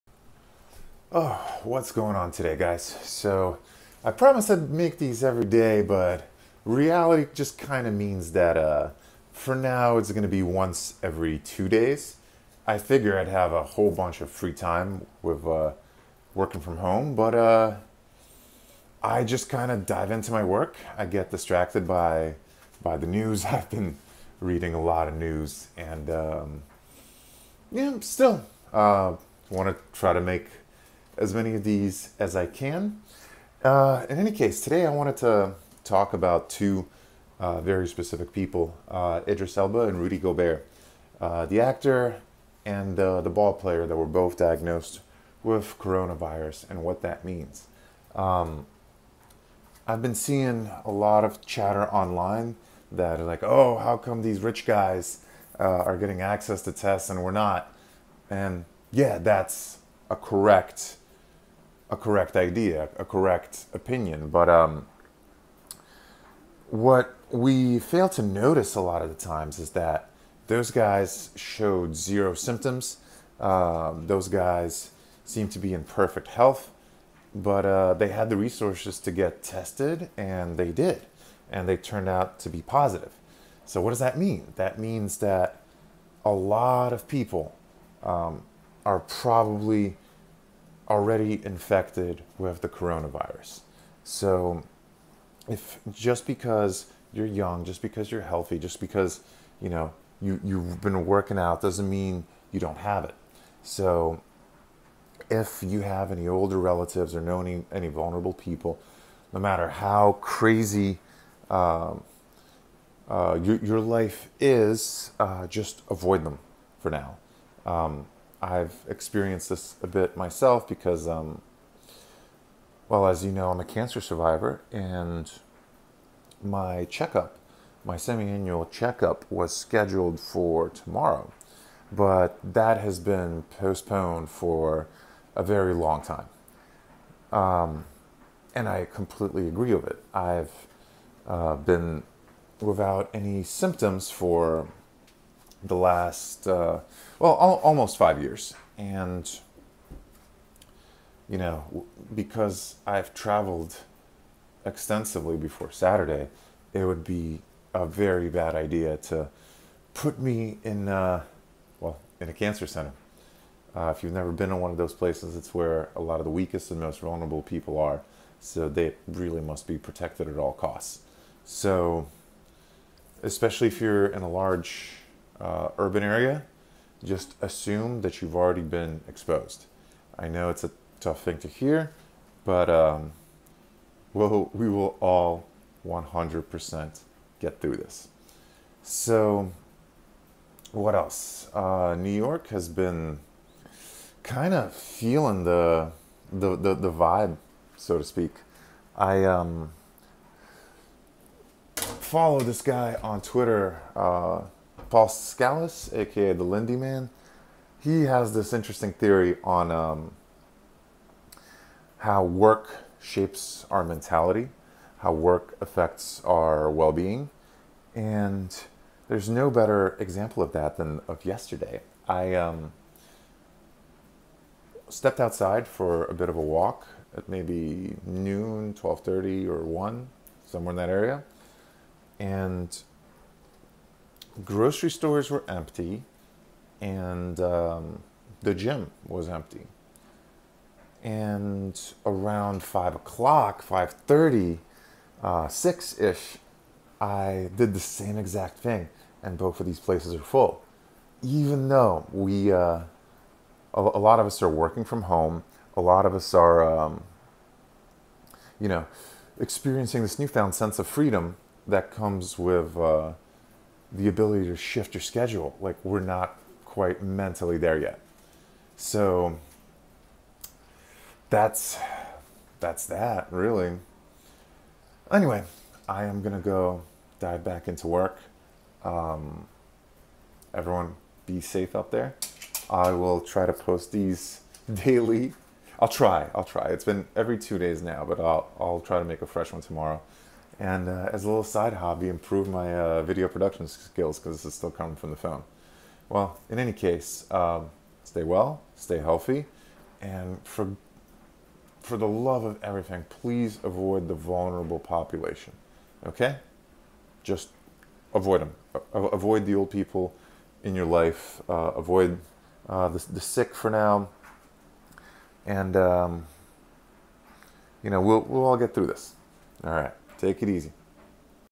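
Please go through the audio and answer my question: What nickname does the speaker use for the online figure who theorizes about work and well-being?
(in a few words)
the Lindy Man.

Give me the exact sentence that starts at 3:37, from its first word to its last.
And there's no better example of that than of yesterday.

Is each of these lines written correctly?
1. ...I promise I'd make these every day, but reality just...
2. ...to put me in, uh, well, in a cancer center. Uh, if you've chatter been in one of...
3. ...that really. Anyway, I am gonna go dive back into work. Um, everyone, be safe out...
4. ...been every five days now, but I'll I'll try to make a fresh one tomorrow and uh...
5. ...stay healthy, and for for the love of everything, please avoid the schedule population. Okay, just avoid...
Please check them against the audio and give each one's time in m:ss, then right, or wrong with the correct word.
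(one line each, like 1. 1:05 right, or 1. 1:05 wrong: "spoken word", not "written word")
1. 0:04 right
2. 2:38 wrong: "never", not "chatter"
3. 4:32 right
4. 4:46 wrong: "two", not "five"
5. 4:58 wrong: "vulnerable", not "schedule".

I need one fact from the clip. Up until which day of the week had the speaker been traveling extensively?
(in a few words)
Saturday.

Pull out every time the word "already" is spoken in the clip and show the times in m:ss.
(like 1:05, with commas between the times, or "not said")
1:30, 2:58.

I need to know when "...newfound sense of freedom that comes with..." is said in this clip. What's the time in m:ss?
4:20.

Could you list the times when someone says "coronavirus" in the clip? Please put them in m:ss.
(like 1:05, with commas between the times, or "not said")
0:45, 1:32.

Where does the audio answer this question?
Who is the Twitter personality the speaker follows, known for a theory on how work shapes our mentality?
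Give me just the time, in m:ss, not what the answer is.
3:24.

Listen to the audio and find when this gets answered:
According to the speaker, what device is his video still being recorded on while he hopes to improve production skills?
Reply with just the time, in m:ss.
4:55.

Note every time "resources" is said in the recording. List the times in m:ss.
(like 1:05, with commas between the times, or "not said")
1:18.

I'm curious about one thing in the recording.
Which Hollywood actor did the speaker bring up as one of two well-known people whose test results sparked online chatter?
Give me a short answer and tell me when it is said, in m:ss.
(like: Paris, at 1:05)
Idris Elba, at 0:39.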